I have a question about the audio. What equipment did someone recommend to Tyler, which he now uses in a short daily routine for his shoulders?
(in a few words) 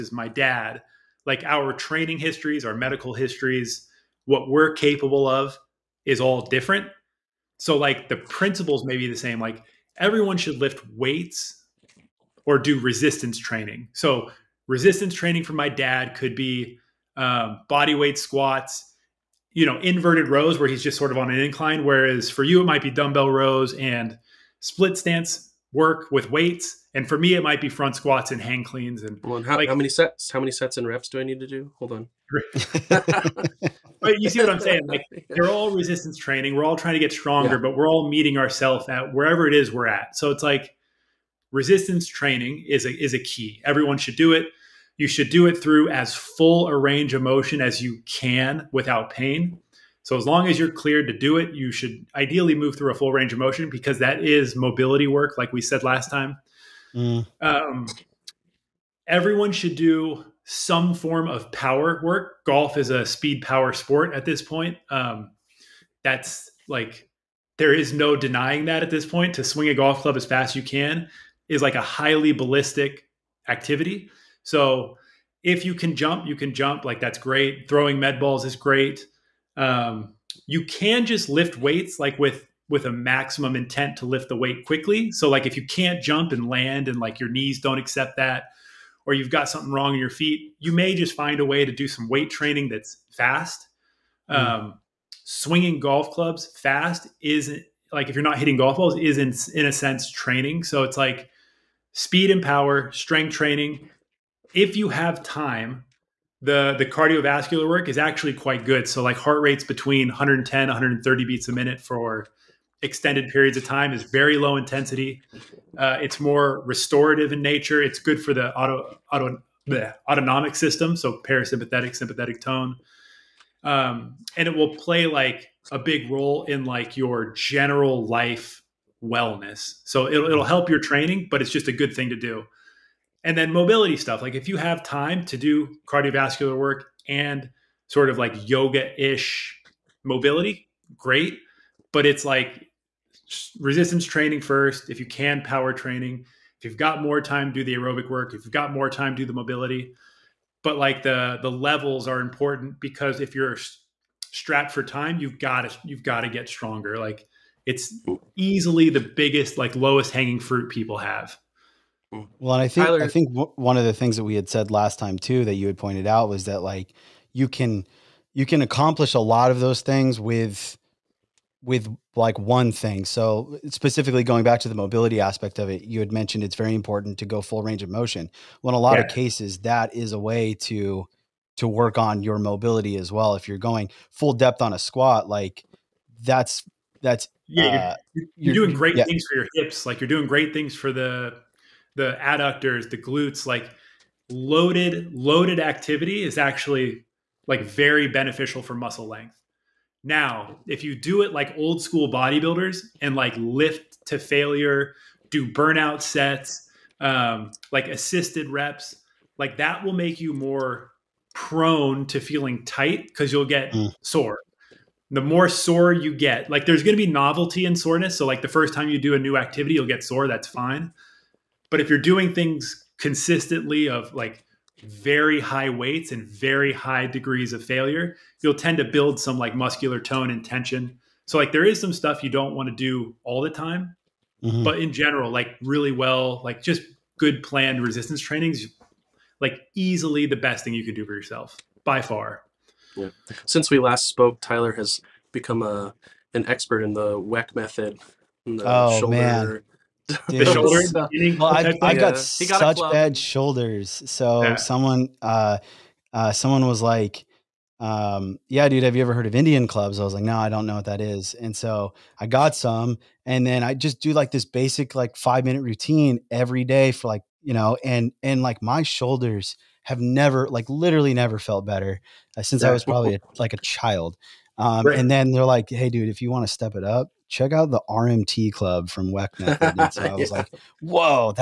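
Indian clubs.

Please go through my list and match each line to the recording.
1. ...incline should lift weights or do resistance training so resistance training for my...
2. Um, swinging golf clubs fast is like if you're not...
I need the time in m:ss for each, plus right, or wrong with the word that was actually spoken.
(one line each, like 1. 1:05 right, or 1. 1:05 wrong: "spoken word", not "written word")
1. 0:09 wrong: "everyone", not "incline"
2. 1:34 right.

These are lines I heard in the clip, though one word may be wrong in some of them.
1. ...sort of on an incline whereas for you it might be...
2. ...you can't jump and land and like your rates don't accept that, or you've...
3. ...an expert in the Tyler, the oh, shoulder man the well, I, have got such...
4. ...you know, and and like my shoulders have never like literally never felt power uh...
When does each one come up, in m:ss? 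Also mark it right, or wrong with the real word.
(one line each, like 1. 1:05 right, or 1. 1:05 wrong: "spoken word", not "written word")
1. 0:20 right
2. 1:25 wrong: "knees", not "rates"
3. 4:06 wrong: "WeckMethod", not "Tyler"
4. 4:27 wrong: "better", not "power".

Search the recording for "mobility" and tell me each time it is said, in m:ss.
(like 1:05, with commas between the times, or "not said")
0:54, 2:13, 2:20, 2:29, 2:54, 3:02.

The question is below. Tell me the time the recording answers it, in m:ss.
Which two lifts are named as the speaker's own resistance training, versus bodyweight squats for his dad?
0:27.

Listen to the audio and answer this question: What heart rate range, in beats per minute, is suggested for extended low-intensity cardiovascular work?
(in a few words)
110-130.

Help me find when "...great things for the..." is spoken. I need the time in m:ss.
3:10.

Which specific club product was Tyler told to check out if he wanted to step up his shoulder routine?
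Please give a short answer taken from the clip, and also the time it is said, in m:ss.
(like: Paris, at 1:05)
RMT club, at 4:37.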